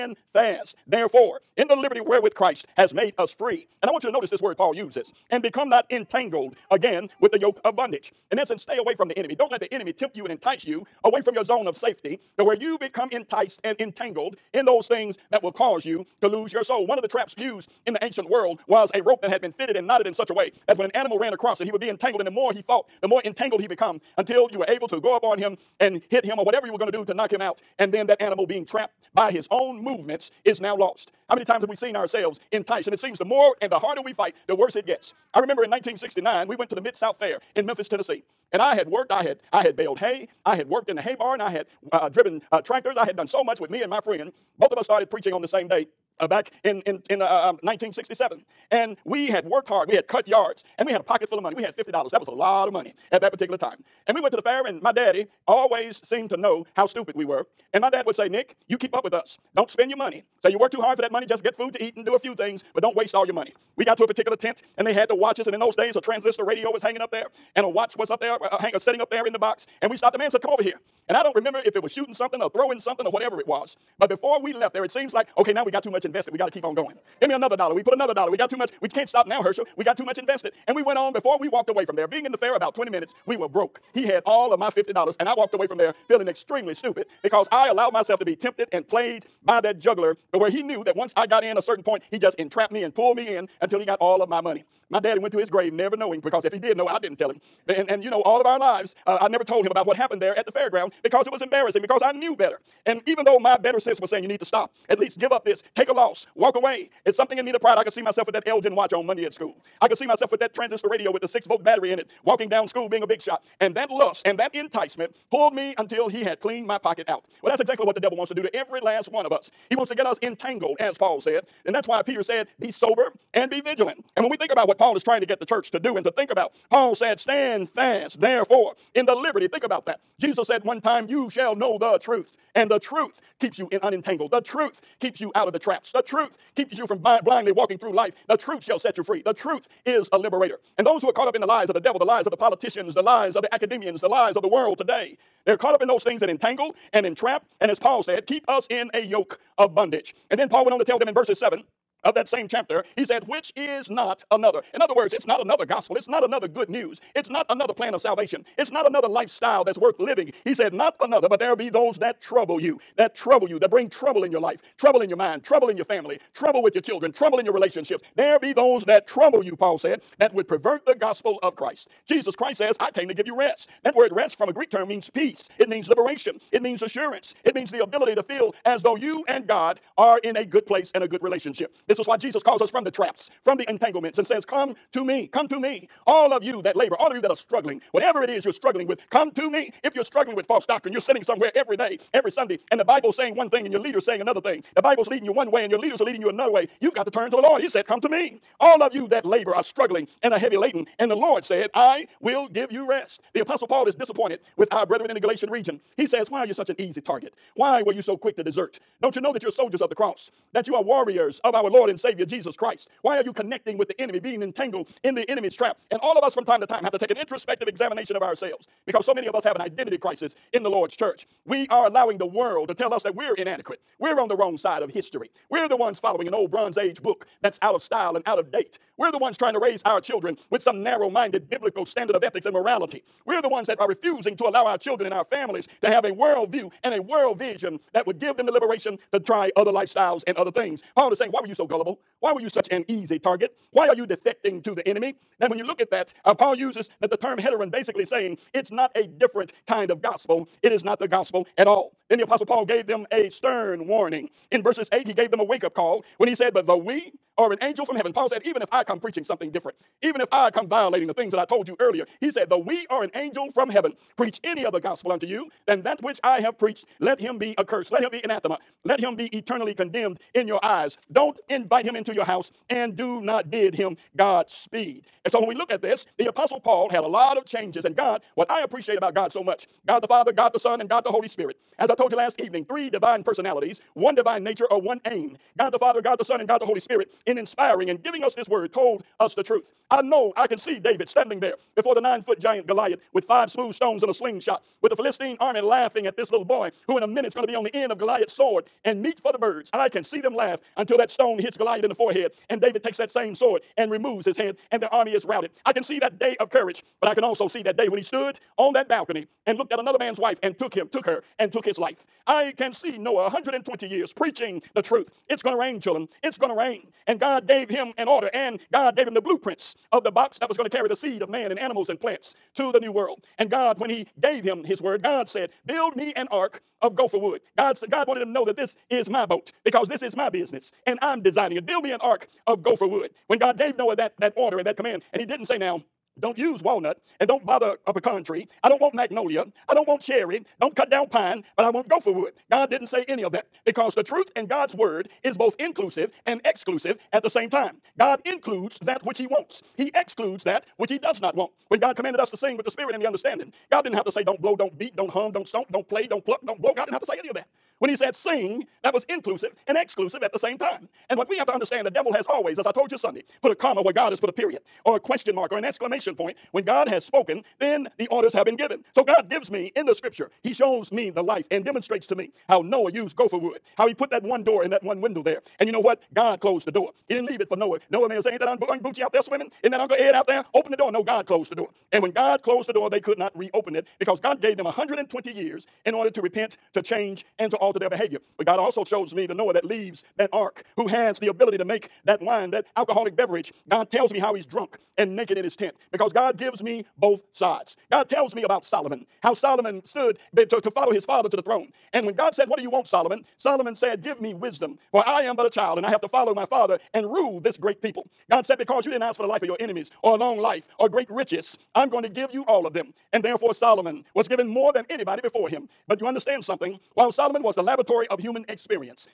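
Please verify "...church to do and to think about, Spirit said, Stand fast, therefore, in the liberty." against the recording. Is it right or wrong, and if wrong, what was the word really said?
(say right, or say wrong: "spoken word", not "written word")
wrong: "Paul", not "Spirit".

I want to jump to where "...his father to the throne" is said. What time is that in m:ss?
6:40.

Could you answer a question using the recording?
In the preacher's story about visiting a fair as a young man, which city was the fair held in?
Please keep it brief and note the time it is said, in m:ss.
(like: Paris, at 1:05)
Memphis, Tennessee, at 0:37.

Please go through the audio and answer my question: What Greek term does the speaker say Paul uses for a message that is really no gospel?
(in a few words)
heteron.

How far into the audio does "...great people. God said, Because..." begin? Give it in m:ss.
6:47.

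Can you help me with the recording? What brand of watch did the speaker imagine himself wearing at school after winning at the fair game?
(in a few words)
Elgin.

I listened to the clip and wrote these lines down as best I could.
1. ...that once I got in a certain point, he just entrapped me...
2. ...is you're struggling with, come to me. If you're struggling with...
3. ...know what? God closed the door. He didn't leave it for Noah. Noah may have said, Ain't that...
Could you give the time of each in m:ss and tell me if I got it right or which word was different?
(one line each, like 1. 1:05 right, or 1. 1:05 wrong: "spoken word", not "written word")
1. 1:30 right
2. 3:08 right
3. 6:15 right.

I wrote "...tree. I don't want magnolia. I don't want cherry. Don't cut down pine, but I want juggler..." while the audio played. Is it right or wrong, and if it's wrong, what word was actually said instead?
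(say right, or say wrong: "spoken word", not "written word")
wrong: "gopher", not "juggler".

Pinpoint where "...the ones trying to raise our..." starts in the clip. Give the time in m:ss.
3:49.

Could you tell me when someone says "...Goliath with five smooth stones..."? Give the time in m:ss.
4:52.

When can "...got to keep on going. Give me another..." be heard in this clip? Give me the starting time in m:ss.
1:16.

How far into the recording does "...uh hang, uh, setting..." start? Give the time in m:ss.
1:08.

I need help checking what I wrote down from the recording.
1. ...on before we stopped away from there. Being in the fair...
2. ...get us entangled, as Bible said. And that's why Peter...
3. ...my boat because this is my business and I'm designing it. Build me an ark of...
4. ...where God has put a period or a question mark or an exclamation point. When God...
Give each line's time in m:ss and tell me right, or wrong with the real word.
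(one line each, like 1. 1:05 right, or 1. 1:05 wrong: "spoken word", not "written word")
1. 1:20 wrong: "walked", not "stopped"
2. 1:59 wrong: "Paul", not "Bible"
3. 5:29 right
4. 6:03 right.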